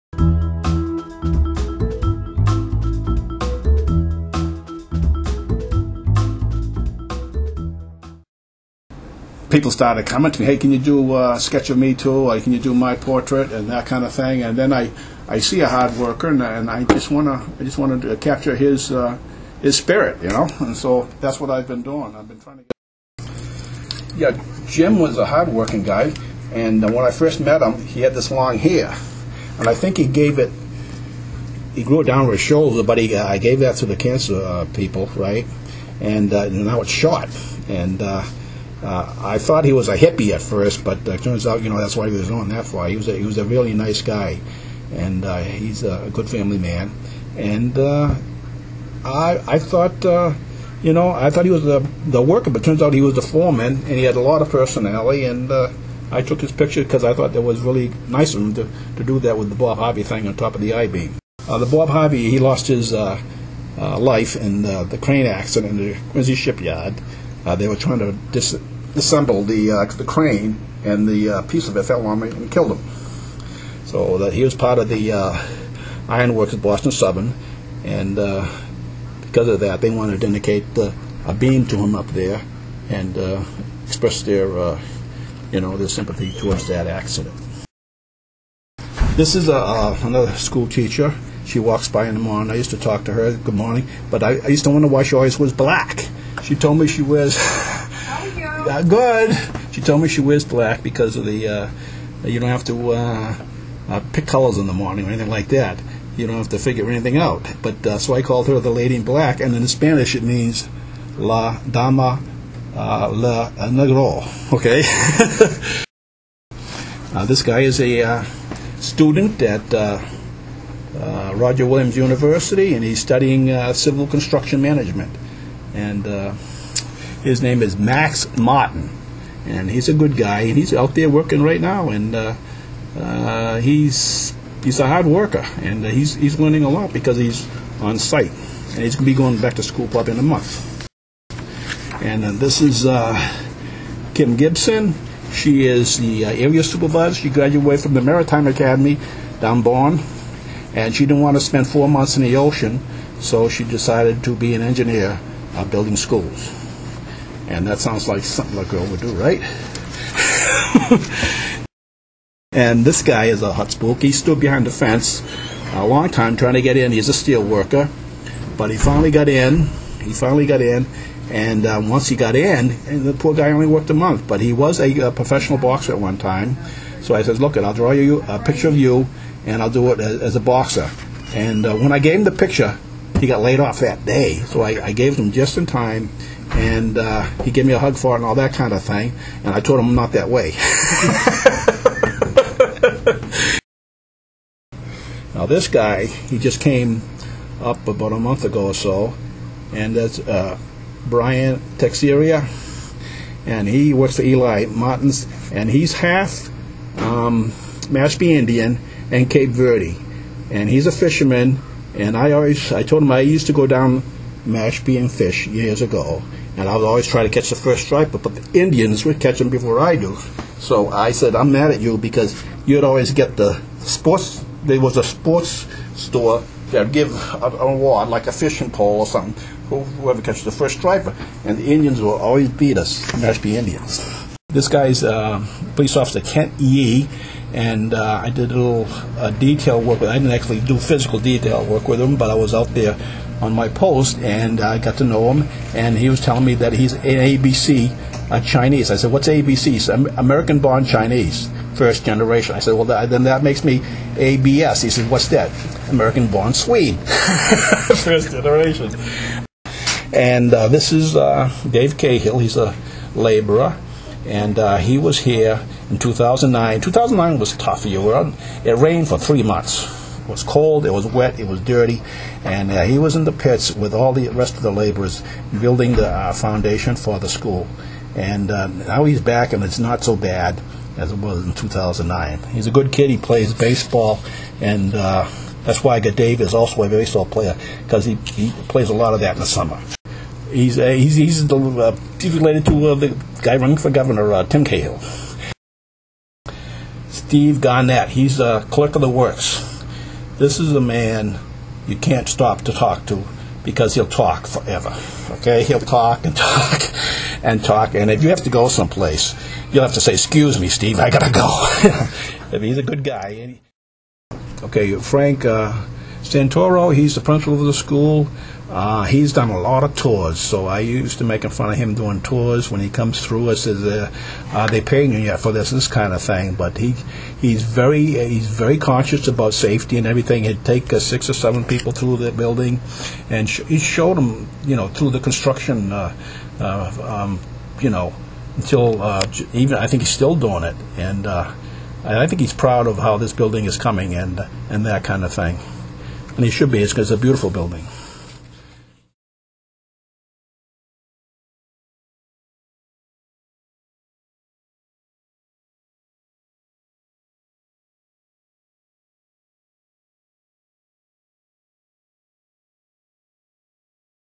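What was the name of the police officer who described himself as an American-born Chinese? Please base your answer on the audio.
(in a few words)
Kent Yee.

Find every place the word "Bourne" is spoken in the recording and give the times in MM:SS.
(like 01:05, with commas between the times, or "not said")
02:29.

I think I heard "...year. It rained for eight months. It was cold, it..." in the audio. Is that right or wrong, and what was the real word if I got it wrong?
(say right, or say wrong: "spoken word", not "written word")
wrong: "three", not "eight".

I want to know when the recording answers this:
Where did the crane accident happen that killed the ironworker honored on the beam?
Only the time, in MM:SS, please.
01:06.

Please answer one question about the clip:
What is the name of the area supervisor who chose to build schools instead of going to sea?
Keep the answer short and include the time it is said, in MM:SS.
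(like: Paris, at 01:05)
Kim Gibson, at 02:24.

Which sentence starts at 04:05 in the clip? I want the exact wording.
And he was telling me that he's an ABC uh, Chinese.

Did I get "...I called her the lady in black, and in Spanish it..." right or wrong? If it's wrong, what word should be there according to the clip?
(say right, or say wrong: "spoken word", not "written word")
right.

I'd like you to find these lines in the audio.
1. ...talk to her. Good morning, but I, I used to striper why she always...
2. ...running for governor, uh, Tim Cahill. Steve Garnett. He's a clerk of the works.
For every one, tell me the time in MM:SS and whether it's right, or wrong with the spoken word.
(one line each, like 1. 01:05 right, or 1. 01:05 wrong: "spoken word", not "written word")
1. 01:32 wrong: "wonder", not "striper"
2. 04:53 right.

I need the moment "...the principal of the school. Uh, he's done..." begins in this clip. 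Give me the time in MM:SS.
05:17.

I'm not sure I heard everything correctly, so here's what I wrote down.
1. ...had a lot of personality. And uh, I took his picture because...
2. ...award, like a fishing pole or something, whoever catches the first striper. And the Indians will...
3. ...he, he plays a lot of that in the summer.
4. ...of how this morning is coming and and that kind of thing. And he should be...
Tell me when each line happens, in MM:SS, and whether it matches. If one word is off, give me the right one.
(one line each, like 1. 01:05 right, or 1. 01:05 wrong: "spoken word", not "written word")
1. 00:54 right
2. 03:47 right
3. 04:48 right
4. 05:42 wrong: "building", not "morning".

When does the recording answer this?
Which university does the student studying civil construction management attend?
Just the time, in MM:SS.
02:01.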